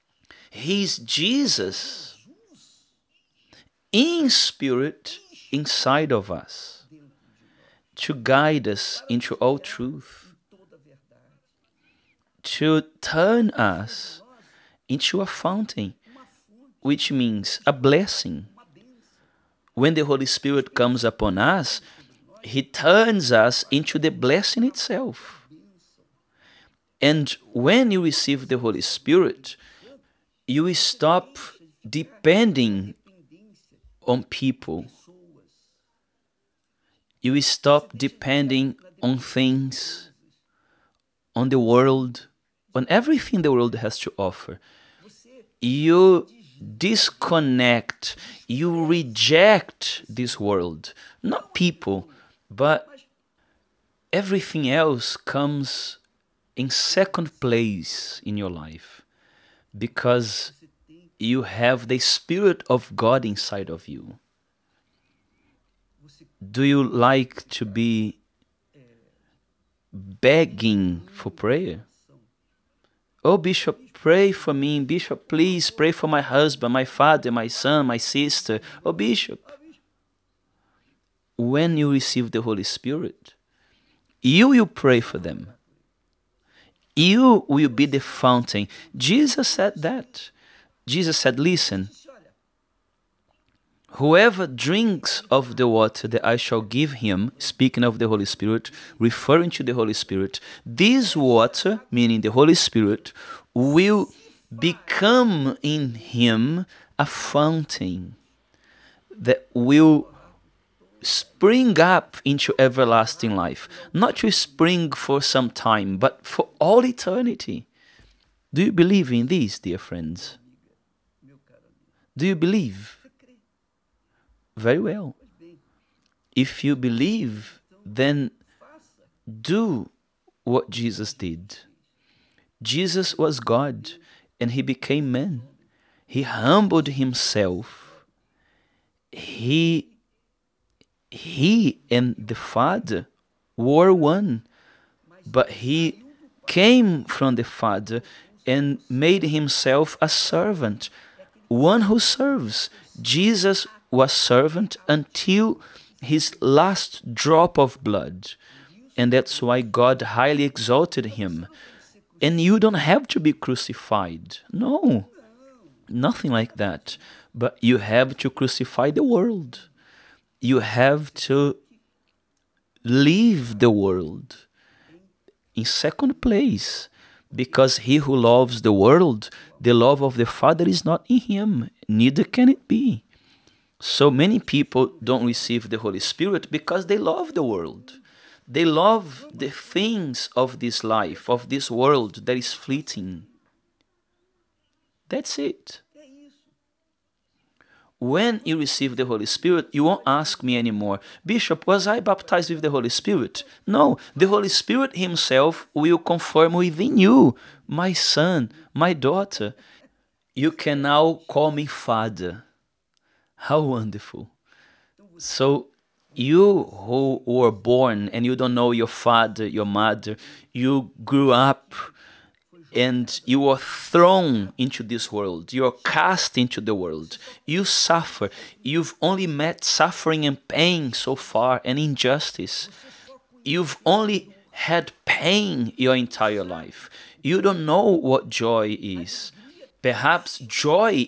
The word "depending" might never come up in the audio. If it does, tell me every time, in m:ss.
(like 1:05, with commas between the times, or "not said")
0:31, 0:38.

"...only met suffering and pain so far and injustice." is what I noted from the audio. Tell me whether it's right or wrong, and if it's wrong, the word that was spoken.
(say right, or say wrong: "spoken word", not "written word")
right.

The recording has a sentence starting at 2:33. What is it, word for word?
Jesus was servant until his last drop of blood, and that's why God highly exalted him.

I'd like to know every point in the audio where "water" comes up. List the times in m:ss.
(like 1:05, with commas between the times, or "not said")
1:35, 1:41.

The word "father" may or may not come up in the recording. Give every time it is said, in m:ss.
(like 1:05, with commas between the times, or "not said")
1:16, 2:22, 2:27, 3:00, 3:31, 3:38.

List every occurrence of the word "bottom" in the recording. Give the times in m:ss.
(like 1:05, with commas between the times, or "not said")
not said.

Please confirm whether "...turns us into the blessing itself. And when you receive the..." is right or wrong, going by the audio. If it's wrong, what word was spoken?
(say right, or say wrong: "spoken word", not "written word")
right.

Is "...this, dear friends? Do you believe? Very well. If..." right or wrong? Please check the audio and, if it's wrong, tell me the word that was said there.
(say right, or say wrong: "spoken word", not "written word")
right.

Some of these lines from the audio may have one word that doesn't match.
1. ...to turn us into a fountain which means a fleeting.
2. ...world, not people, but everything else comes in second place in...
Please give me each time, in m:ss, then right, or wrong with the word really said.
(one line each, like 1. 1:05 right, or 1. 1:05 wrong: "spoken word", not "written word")
1. 0:12 wrong: "blessing", not "fleeting"
2. 0:50 right.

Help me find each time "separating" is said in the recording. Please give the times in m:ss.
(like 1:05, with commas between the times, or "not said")
not said.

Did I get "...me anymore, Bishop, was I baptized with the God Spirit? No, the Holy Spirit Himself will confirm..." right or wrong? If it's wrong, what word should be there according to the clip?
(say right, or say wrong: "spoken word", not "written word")
wrong: "Holy", not "God".